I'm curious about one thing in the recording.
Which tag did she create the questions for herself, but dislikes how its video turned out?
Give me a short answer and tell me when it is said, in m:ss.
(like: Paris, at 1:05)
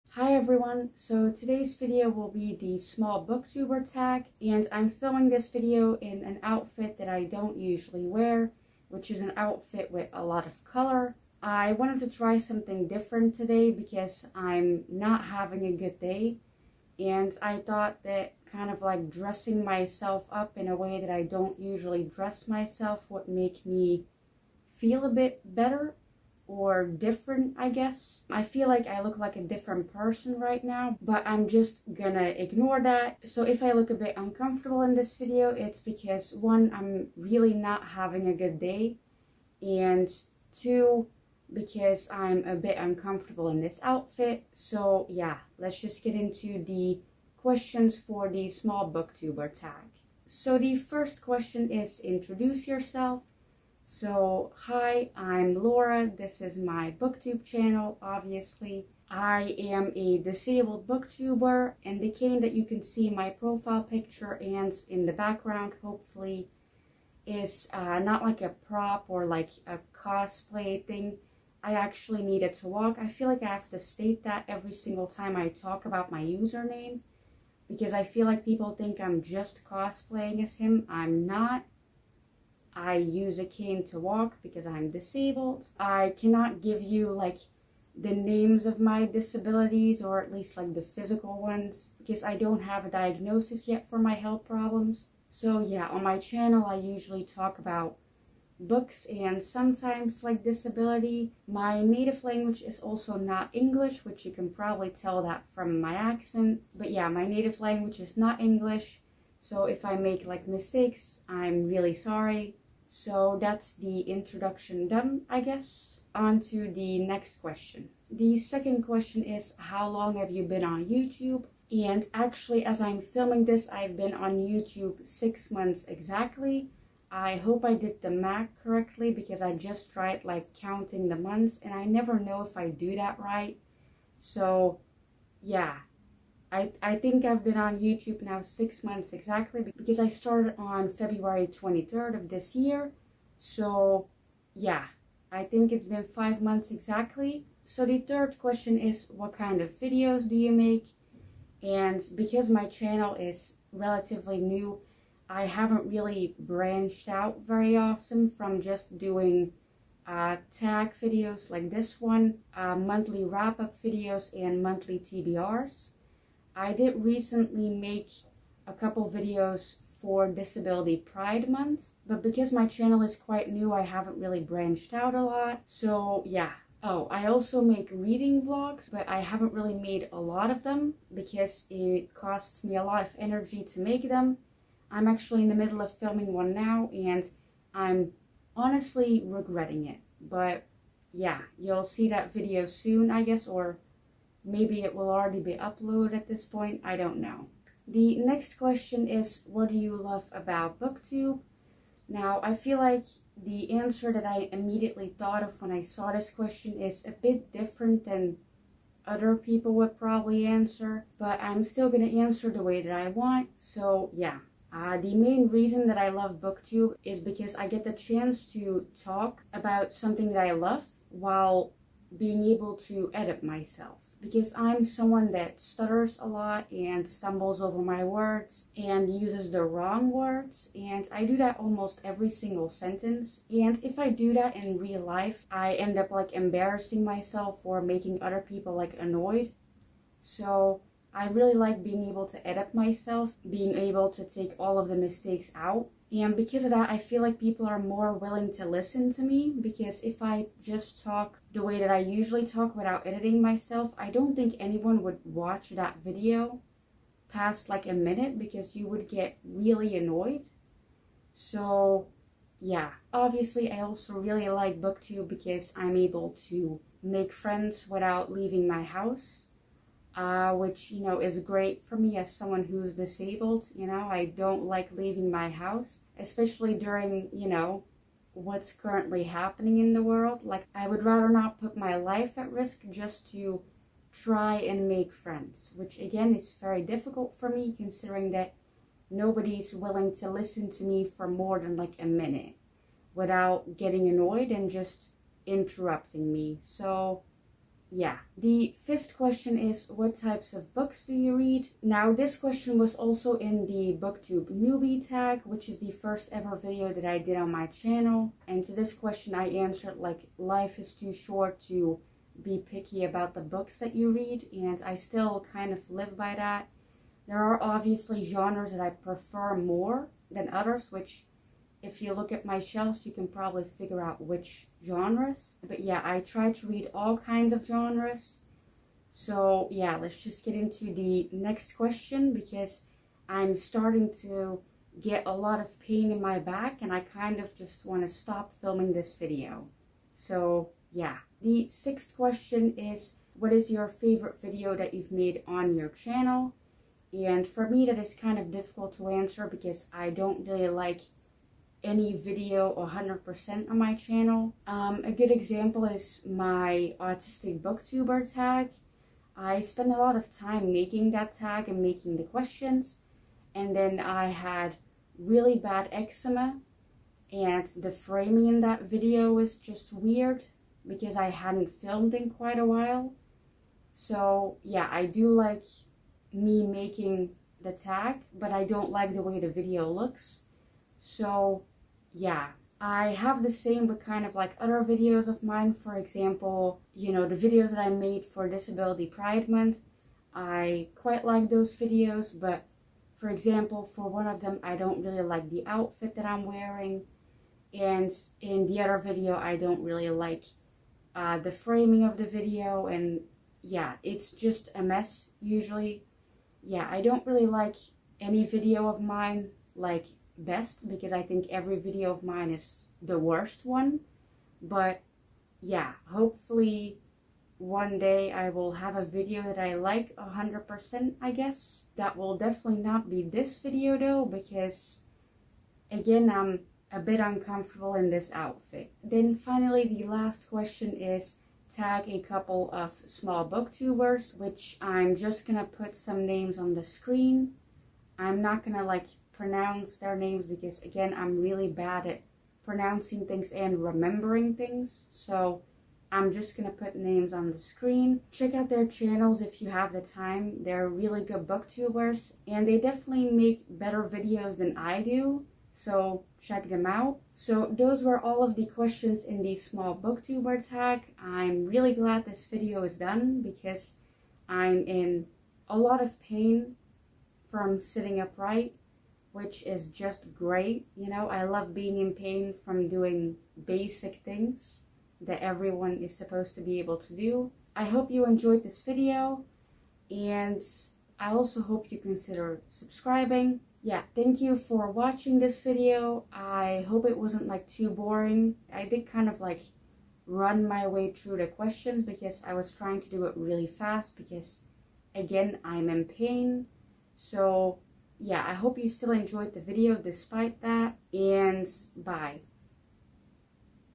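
Autistic booktuber tag, at 5:56.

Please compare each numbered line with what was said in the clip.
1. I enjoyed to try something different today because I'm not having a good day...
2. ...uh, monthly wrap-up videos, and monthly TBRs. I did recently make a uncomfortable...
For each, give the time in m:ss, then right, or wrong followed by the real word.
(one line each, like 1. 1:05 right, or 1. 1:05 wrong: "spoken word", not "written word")
1. 0:11 wrong: "wanted", not "enjoyed"
2. 2:42 wrong: "couple", not "uncomfortable".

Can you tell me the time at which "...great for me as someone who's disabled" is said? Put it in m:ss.
4:31.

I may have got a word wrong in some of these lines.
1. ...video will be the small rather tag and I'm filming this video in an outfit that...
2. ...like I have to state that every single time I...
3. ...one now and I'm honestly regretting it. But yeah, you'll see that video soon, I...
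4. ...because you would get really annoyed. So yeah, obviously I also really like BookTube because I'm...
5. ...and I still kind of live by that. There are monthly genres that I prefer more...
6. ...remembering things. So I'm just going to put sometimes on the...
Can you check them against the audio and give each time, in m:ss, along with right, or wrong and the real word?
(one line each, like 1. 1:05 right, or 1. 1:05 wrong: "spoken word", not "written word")
1. 0:01 wrong: "booktuber", not "rather"
2. 1:13 right
3. 3:06 right
4. 4:18 right
5. 5:14 wrong: "obviously", not "monthly"
6. 7:23 wrong: "names", not "sometimes".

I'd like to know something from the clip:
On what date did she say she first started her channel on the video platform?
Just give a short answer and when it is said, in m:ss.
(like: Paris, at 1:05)
February 23rd, at 2:20.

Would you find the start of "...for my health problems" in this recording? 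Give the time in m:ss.
1:33.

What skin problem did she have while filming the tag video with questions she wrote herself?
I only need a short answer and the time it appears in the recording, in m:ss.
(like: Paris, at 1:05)
Eczema, at 6:05.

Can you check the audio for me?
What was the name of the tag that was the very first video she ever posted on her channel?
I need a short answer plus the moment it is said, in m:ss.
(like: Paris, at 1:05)
BookTube newbie tag, at 5:03.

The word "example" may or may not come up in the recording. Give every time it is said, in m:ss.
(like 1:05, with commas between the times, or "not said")
5:55, 6:25, 6:33.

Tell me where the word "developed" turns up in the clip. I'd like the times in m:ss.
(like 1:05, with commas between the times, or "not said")
not said.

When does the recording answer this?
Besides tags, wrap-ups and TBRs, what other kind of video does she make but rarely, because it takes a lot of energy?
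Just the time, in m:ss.
2:57.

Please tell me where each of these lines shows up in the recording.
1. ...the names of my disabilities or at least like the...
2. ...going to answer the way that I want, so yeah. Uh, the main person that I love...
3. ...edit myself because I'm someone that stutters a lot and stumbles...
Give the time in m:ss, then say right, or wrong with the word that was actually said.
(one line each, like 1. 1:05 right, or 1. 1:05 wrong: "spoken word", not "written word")
1. 1:27 right
2. 3:31 wrong: "reason", not "person"
3. 3:43 right.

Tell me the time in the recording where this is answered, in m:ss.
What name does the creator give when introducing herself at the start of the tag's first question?
0:55.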